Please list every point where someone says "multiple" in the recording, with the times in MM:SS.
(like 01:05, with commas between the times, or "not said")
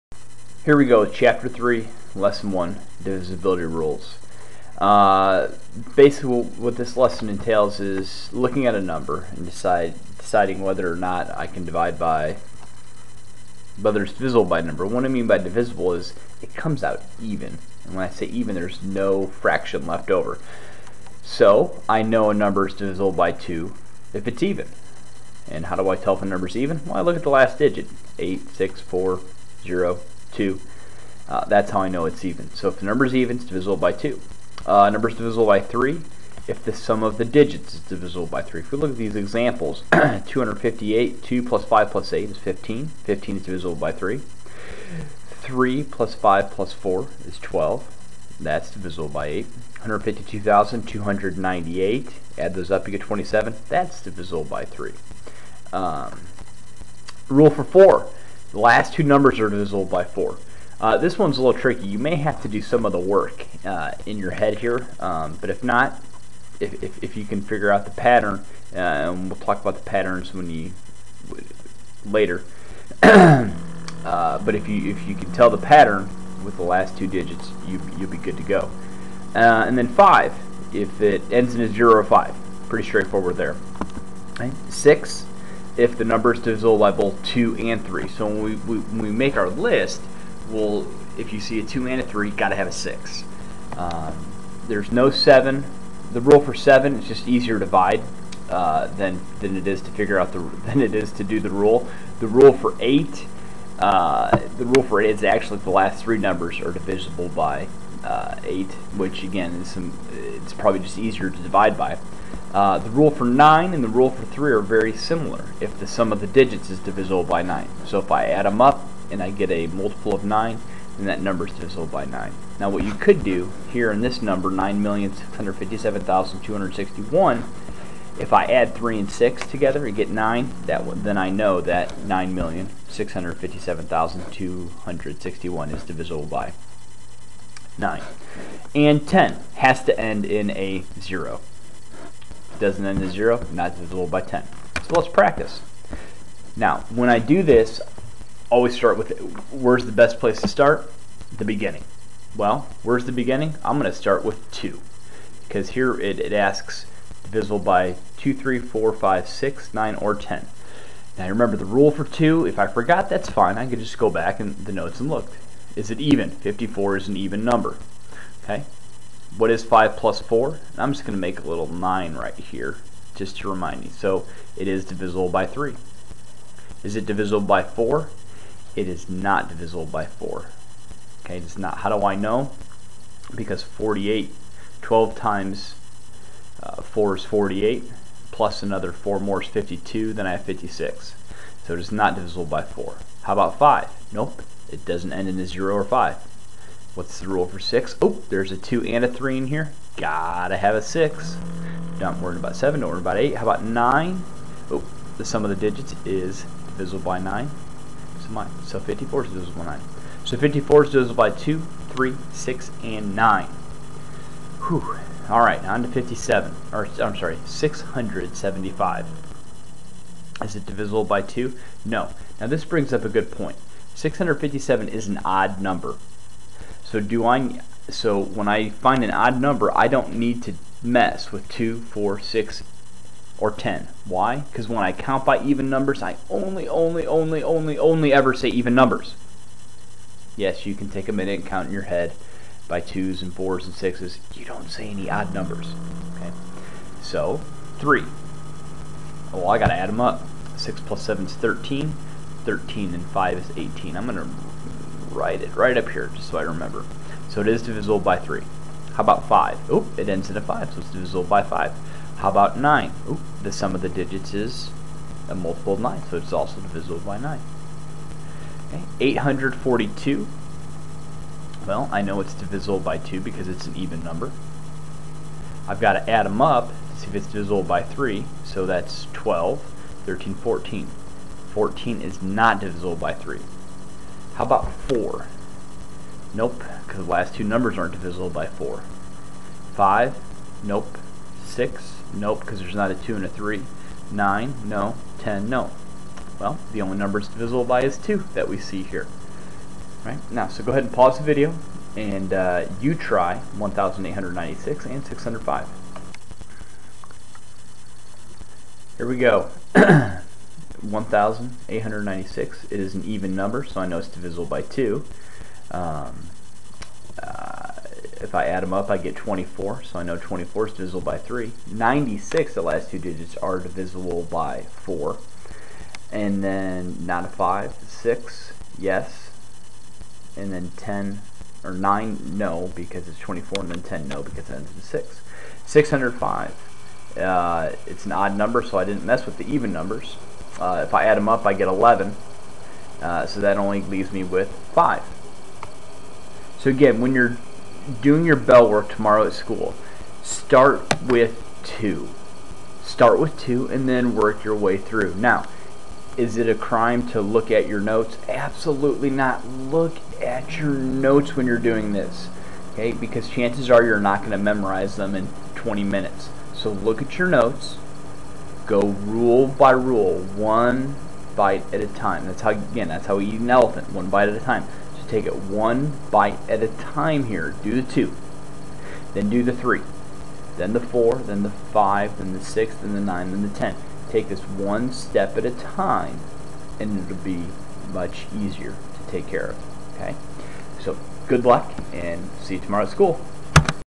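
01:59, 04:25.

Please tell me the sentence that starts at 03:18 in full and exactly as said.
Oh, there's a 2 and a 3 in here.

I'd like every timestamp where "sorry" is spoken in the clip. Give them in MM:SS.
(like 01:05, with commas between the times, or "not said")
03:37.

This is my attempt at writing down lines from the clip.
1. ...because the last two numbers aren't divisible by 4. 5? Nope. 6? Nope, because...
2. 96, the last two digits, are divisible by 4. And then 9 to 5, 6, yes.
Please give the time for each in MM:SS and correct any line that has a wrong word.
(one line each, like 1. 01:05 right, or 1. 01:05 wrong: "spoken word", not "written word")
1. 04:46 right
2. 05:21 right.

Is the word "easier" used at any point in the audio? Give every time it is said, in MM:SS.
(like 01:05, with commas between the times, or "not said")
01:37, 01:50, 06:28.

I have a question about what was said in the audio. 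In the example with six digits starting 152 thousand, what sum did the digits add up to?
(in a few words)
27.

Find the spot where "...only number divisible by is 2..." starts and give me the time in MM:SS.
04:56.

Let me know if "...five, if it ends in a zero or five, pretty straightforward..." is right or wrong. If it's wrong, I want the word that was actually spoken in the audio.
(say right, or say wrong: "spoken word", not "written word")
right.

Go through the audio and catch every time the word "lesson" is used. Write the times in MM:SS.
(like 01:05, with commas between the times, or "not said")
00:02, 00:06.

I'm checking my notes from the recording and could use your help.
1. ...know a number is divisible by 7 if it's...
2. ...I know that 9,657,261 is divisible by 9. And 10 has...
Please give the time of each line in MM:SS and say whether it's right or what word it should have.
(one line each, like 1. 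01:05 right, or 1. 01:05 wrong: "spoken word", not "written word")
1. 00:22 wrong: "2", not "7"
2. 02:11 right.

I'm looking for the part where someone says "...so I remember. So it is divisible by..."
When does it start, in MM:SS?
04:16.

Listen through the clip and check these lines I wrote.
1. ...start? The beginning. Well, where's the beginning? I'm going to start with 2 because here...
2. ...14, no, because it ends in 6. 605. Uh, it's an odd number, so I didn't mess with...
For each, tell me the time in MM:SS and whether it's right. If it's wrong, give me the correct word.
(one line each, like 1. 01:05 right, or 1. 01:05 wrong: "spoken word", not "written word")
1. 02:30 right
2. 05:33 wrong: "10", not "14".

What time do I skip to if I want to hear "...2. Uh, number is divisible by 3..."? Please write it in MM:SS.
00:33.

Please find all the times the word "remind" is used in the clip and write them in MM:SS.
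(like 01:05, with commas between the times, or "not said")
02:53.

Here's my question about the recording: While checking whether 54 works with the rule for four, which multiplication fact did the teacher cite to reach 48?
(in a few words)
12 times 4.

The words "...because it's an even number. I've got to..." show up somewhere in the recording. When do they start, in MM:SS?
04:33.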